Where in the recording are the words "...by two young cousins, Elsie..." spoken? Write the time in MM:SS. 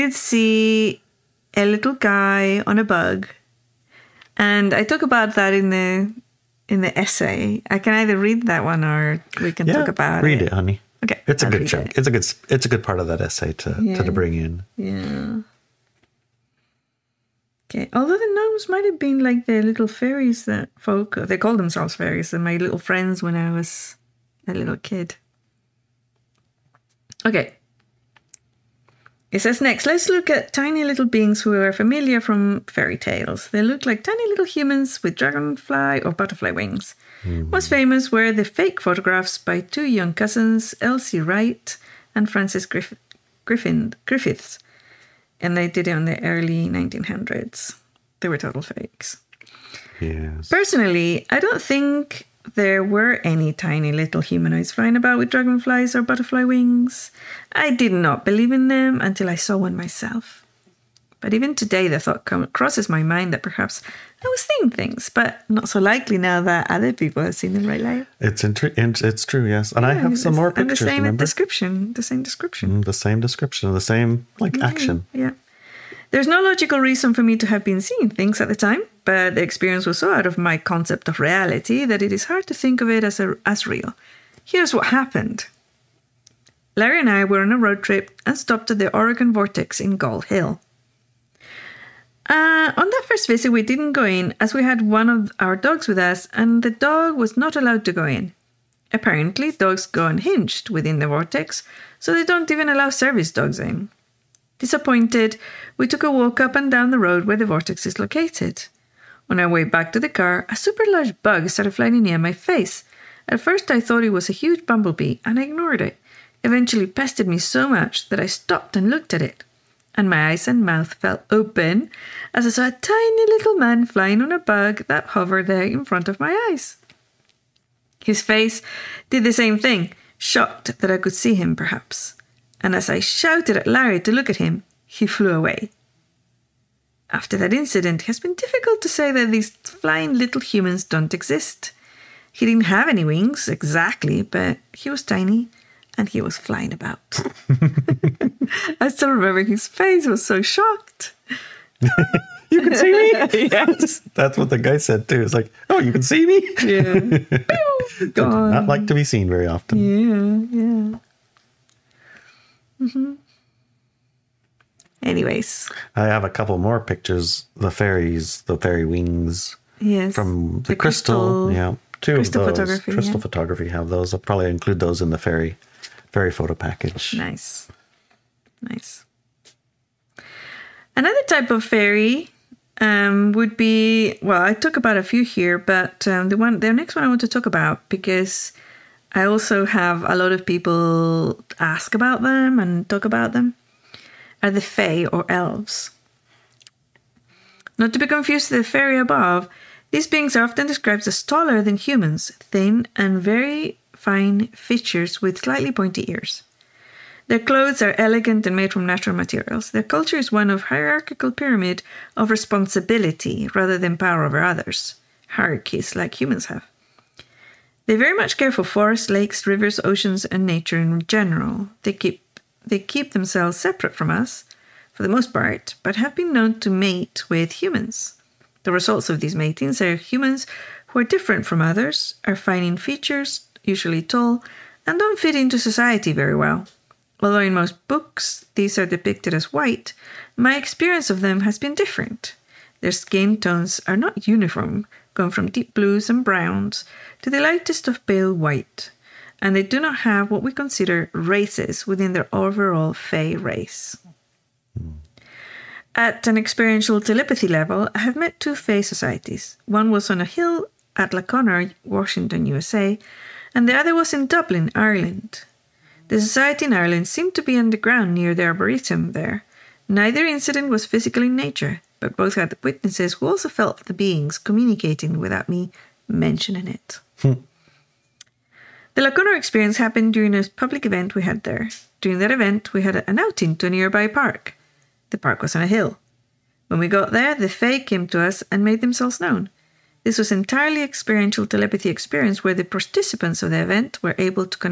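00:39.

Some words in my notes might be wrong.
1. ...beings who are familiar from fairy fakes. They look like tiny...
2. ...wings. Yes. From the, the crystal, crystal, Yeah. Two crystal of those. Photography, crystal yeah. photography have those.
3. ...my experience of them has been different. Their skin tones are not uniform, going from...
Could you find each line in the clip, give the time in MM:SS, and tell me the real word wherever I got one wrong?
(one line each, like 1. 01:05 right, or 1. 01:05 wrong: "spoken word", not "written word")
1. 00:31 wrong: "tales", not "fakes"
2. 02:48 right
3. 04:00 right.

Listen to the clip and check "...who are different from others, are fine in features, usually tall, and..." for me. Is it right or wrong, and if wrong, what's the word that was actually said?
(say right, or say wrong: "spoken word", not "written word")
right.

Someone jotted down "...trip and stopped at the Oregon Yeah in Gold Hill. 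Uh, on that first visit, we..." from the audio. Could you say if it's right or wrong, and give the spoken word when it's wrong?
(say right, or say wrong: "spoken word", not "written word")
wrong: "Vortex", not "Yeah".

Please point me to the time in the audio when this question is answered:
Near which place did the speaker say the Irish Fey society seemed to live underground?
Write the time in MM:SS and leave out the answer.
04:28.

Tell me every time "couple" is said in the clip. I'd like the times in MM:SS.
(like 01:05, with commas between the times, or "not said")
02:46.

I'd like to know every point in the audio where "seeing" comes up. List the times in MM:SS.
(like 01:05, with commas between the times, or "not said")
01:04, 01:17.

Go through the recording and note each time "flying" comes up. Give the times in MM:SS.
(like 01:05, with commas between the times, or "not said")
00:54, 01:51, 02:03, 02:19, 02:26.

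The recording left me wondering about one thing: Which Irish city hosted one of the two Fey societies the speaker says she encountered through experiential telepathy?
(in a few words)
Dublin.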